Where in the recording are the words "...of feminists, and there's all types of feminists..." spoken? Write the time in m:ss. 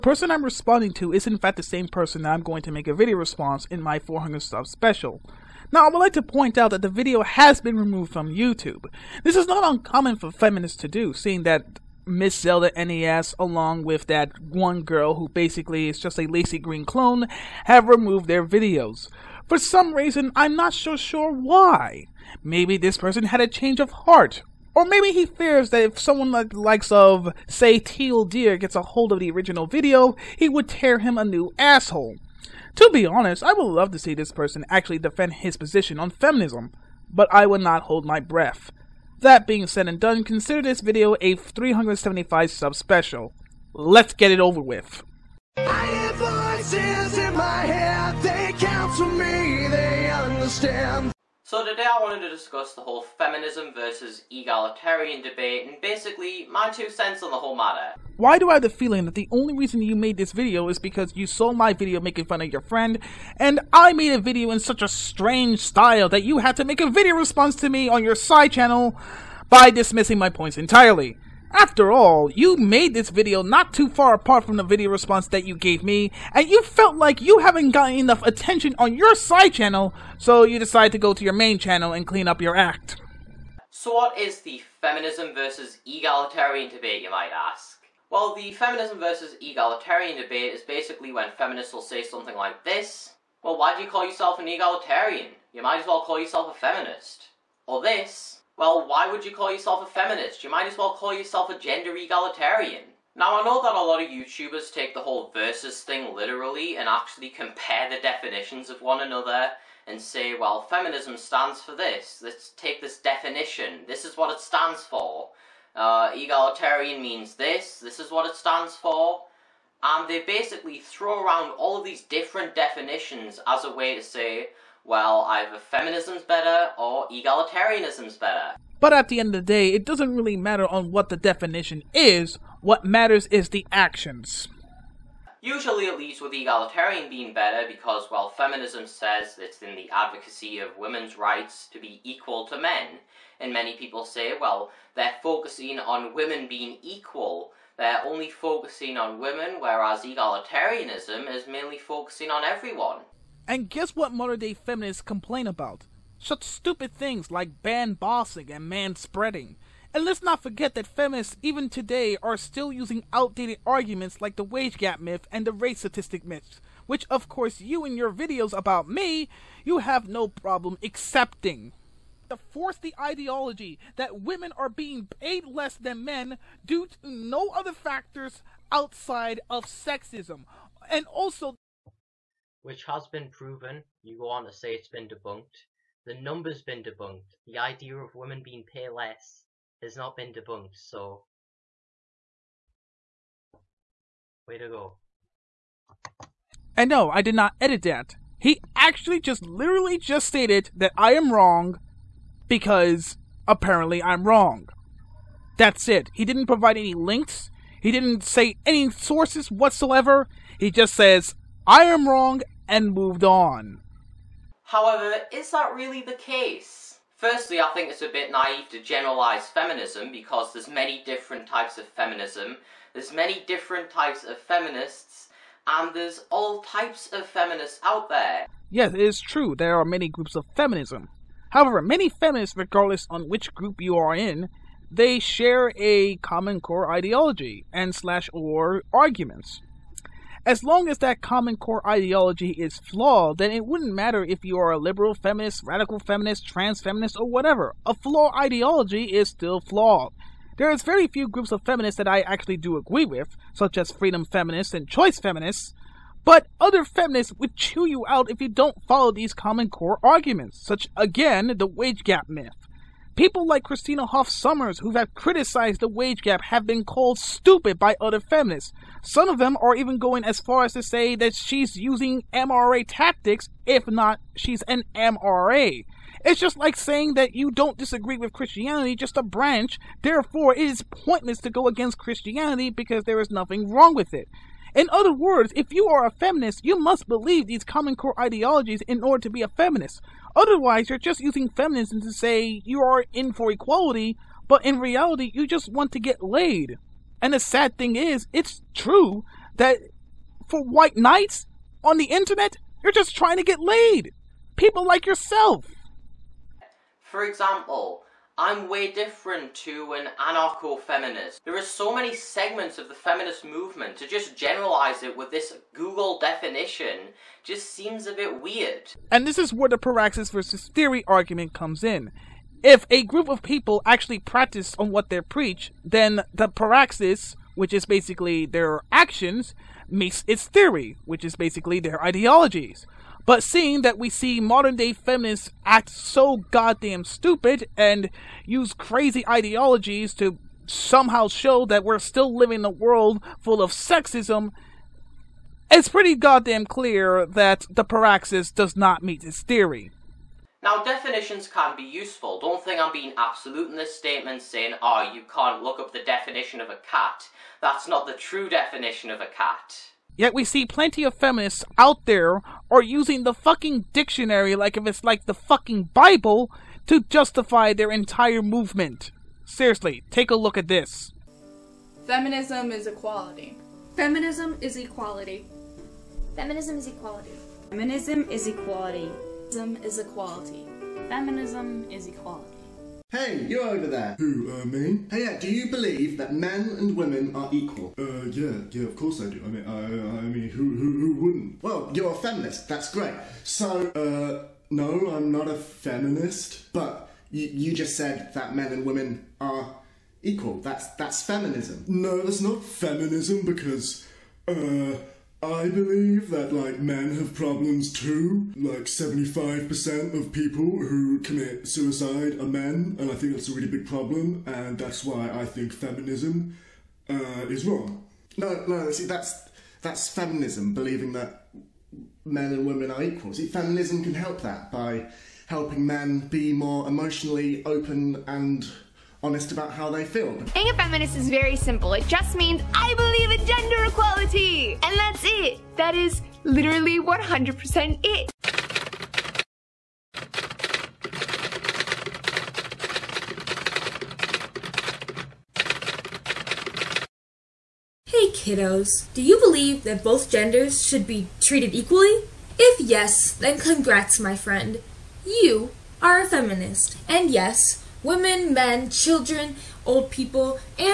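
3:44.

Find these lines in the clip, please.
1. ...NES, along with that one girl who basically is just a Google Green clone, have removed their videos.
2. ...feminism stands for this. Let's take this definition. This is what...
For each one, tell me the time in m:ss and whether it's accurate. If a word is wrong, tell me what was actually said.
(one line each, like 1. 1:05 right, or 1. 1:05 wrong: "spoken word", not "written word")
1. 0:12 wrong: "Laci", not "Google"
2. 1:50 right.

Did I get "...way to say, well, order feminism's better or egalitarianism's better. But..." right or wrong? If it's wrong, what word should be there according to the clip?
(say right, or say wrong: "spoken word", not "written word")
wrong: "either", not "order".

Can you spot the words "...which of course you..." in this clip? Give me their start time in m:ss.
2:46.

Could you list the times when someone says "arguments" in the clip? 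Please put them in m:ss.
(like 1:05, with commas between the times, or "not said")
2:43, 3:58, 4:20, 5:21.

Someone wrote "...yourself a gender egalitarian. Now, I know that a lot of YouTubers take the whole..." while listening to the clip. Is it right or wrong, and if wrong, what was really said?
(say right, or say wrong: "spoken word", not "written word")
right.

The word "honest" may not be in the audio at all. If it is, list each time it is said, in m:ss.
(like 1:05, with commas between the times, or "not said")
0:33, 7:09.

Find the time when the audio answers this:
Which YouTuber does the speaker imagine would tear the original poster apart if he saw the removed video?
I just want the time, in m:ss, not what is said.
0:27.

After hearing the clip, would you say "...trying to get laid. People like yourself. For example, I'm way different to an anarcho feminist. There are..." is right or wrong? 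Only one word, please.
right.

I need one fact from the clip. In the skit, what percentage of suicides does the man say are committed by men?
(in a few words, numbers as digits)
75%.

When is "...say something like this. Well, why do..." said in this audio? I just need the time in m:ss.
1:31.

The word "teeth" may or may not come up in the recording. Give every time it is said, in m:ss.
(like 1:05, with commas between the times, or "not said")
not said.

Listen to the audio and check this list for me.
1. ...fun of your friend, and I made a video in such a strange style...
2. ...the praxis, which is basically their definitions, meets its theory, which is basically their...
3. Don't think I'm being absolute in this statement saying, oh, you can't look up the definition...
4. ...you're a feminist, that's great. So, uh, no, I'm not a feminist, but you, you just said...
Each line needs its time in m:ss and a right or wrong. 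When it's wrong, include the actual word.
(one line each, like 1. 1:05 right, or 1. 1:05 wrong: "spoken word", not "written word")
1. 1:02 right
2. 5:26 wrong: "actions", not "definitions"
3. 5:52 right
4. 6:31 right.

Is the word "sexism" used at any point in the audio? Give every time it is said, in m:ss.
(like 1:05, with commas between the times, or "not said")
2:59, 5:43.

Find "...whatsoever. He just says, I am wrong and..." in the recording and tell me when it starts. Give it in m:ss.
3:29.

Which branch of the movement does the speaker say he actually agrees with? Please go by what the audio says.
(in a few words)
freedom feminists.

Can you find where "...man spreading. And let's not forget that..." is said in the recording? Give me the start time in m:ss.
2:38.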